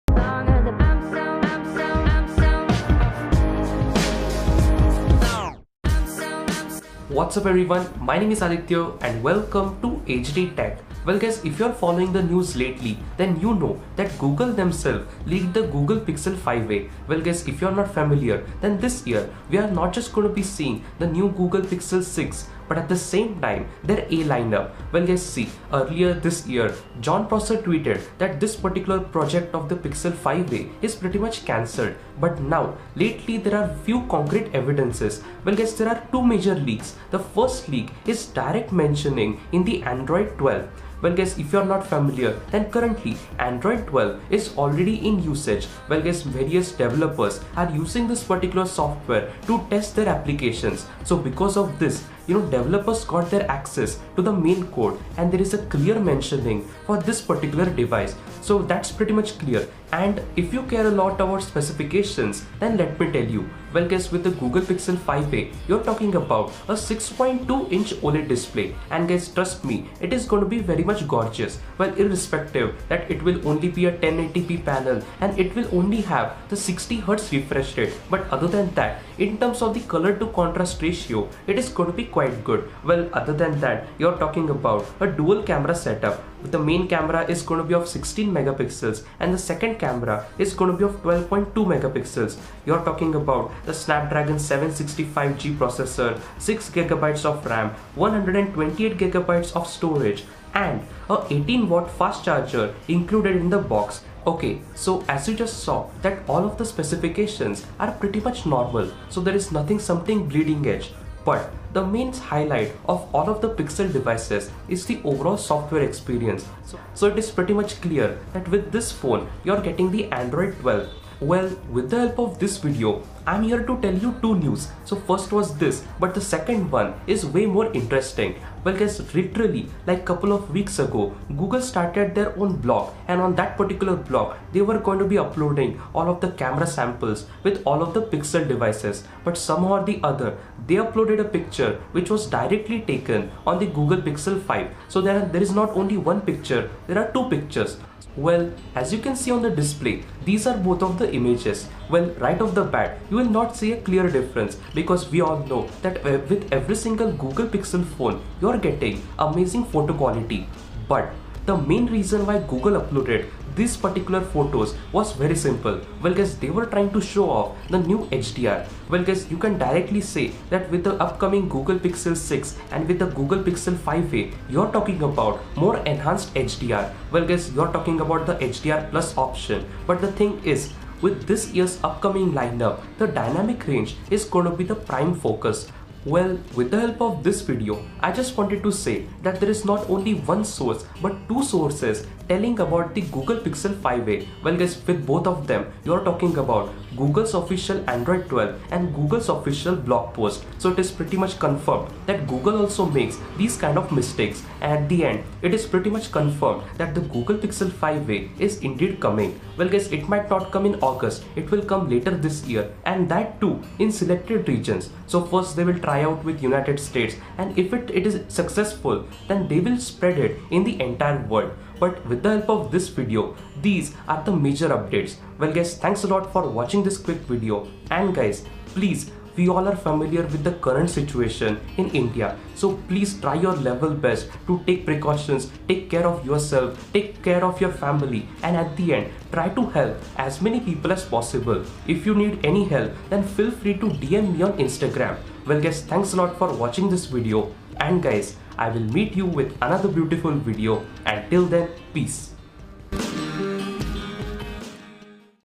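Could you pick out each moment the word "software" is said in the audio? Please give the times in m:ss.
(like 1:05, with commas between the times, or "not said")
0:48, 1:55.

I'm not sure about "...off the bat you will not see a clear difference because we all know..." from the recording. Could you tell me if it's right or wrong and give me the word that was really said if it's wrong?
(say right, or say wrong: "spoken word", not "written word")
right.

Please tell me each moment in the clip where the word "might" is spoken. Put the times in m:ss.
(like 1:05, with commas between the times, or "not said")
3:30.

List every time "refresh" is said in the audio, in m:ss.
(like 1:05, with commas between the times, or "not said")
1:17.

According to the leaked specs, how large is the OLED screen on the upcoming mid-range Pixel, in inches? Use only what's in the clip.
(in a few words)
6.2 inches.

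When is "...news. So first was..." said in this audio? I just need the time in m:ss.
2:04.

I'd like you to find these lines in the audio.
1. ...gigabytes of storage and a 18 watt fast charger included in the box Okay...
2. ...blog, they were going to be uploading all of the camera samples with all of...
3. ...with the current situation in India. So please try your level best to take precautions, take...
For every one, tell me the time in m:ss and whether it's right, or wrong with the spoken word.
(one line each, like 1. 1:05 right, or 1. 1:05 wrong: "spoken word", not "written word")
1. 1:38 right
2. 2:13 right
3. 3:50 right.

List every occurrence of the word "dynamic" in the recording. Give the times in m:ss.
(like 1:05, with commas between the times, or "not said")
3:03.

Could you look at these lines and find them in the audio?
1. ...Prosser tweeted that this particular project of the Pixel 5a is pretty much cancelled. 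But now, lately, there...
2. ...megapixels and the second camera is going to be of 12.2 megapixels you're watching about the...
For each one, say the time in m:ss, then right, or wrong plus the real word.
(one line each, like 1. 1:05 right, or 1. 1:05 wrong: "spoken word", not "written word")
1. 0:27 right
2. 1:28 wrong: "talking", not "watching".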